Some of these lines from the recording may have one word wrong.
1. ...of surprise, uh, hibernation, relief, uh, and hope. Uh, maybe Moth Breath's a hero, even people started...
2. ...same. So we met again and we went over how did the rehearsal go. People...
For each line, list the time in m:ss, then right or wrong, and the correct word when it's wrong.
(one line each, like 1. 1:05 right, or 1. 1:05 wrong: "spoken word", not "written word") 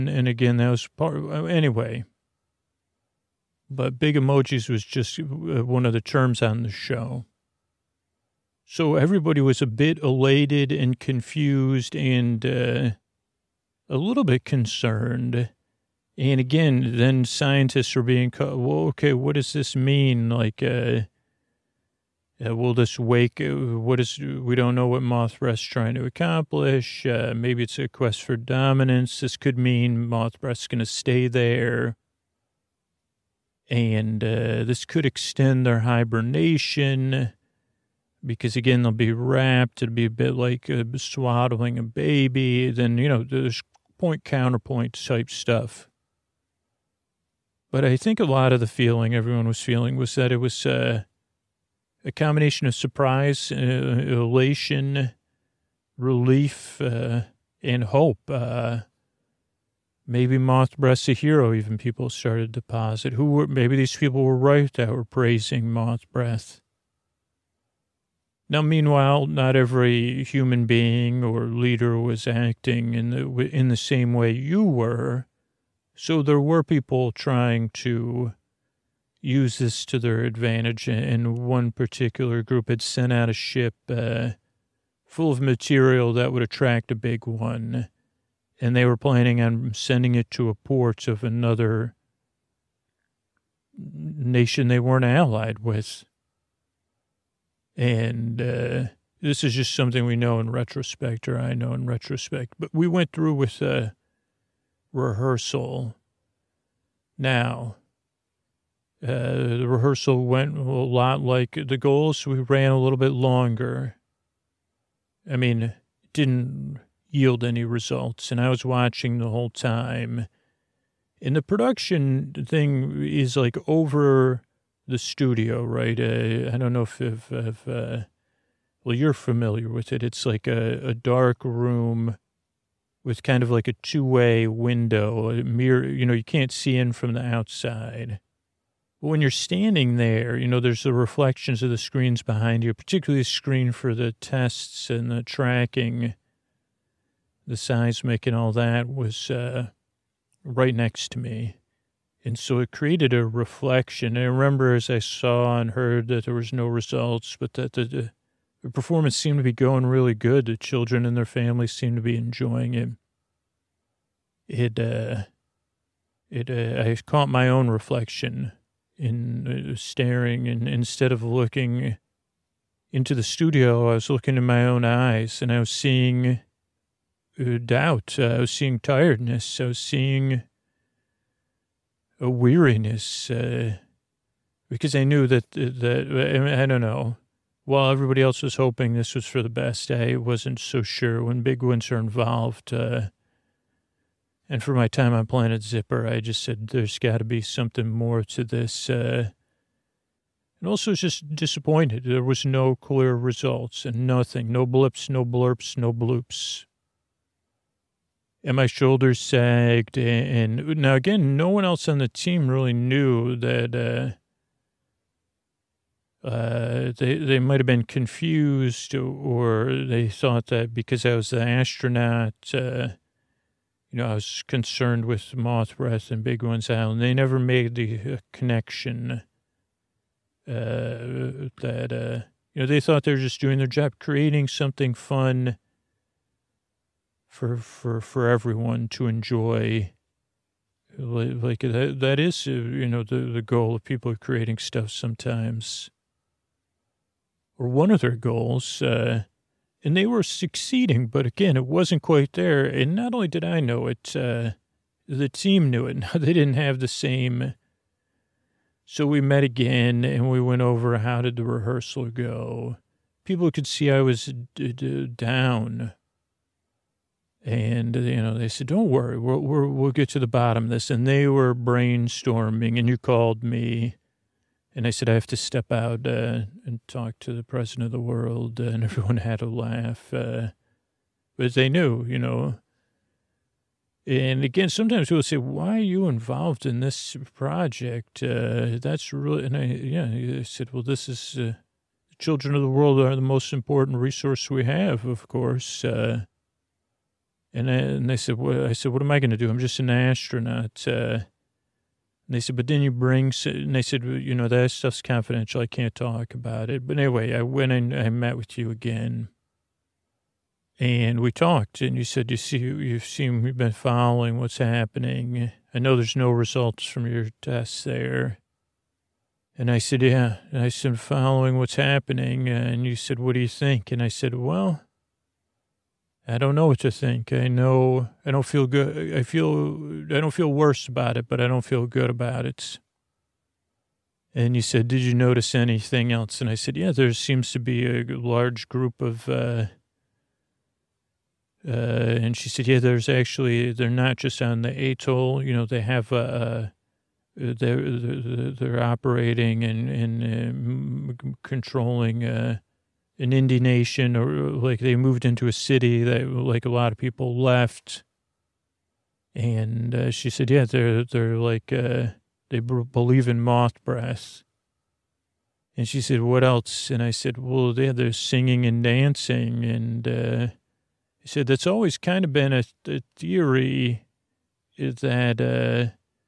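1. 0:52 wrong: "elation", not "hibernation"
2. 4:16 right.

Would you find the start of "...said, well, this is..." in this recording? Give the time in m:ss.
4:50.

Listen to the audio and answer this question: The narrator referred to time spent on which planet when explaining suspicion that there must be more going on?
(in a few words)
Planet Zipper.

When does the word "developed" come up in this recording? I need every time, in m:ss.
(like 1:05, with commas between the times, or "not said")
not said.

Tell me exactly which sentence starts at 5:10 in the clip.
And we talked, and you said, you see, you've seen, we have been following what's happening.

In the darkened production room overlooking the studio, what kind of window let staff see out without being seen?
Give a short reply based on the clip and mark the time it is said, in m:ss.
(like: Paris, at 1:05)
two way window, at 2:13.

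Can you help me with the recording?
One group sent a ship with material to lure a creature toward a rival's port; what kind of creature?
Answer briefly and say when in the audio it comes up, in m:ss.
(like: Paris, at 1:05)
a big one, at 1:26.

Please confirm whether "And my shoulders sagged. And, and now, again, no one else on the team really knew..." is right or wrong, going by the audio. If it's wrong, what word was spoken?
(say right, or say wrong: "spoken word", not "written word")
right.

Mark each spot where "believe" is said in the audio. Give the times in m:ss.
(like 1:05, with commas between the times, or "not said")
6:02.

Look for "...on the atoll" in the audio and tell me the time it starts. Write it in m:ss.
5:44.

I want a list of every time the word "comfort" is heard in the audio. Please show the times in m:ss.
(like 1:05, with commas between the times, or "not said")
not said.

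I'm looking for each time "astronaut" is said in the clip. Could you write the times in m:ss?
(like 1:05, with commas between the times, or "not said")
3:41, 4:59.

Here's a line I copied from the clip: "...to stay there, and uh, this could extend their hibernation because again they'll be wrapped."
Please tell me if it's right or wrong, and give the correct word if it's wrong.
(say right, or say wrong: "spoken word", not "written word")
right.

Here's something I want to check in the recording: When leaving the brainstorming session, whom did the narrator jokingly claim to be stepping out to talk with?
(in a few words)
the president of the world.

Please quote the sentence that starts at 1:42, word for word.
But we went through with a rehearsal.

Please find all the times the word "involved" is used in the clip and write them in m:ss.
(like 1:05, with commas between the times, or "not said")
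3:11, 4:46.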